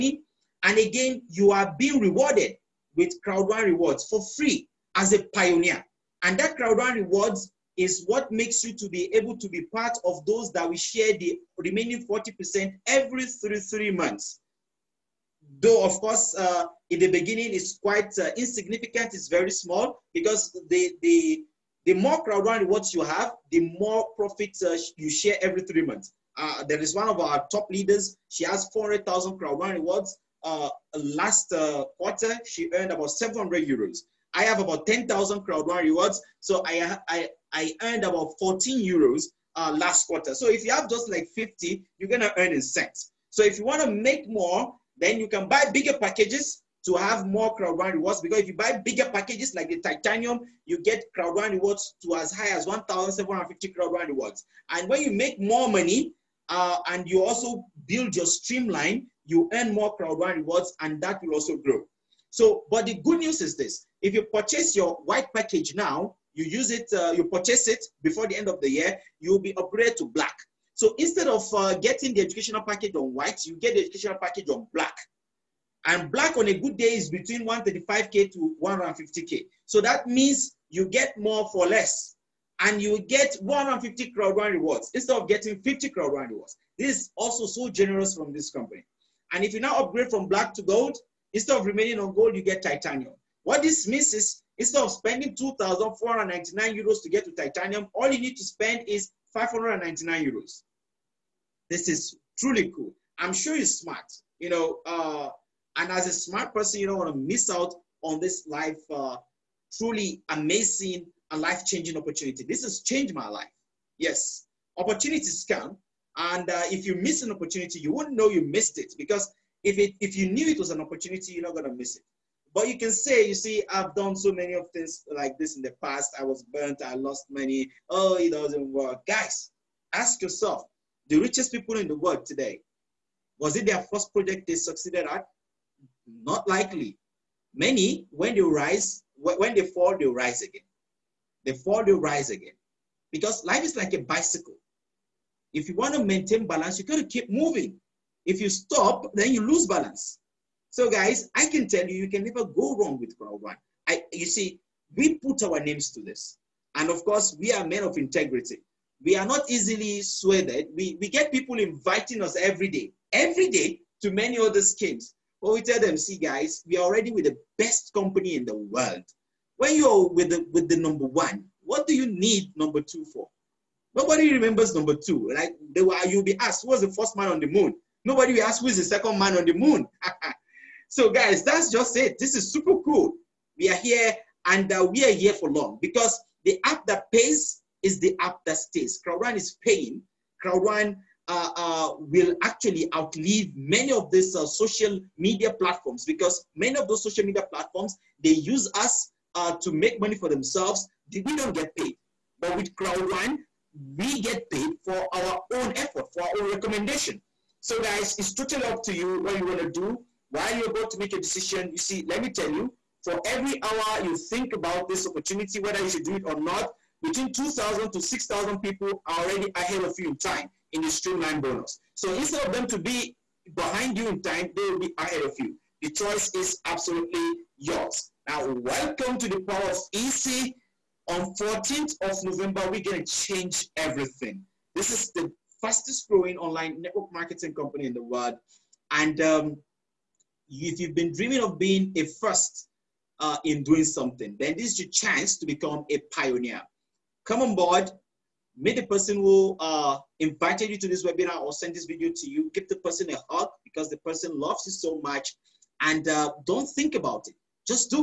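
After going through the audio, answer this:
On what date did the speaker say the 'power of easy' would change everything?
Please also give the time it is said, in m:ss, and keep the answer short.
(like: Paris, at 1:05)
14th of November, at 3:51.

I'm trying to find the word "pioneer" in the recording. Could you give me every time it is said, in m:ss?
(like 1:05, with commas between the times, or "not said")
0:05, 4:06.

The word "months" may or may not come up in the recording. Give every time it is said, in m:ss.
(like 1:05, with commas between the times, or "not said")
0:13, 0:25.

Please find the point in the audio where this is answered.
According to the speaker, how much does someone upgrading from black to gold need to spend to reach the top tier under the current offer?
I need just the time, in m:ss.
1:39.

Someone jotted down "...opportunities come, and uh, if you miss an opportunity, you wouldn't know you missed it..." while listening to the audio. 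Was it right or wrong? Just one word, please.
right.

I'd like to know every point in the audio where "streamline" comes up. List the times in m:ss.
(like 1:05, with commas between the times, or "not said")
0:58, 3:40.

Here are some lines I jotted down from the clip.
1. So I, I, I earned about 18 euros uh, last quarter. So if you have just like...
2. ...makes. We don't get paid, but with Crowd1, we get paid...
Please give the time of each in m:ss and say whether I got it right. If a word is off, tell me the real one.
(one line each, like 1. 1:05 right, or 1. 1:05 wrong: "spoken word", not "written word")
1. 0:36 wrong: "14", not "18"
2. 3:20 wrong: "themselves", not "makes".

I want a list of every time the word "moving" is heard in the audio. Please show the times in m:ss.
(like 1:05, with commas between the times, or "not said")
2:27.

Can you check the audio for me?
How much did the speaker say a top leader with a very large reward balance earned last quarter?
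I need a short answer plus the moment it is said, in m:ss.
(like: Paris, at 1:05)
700 euros, at 0:33.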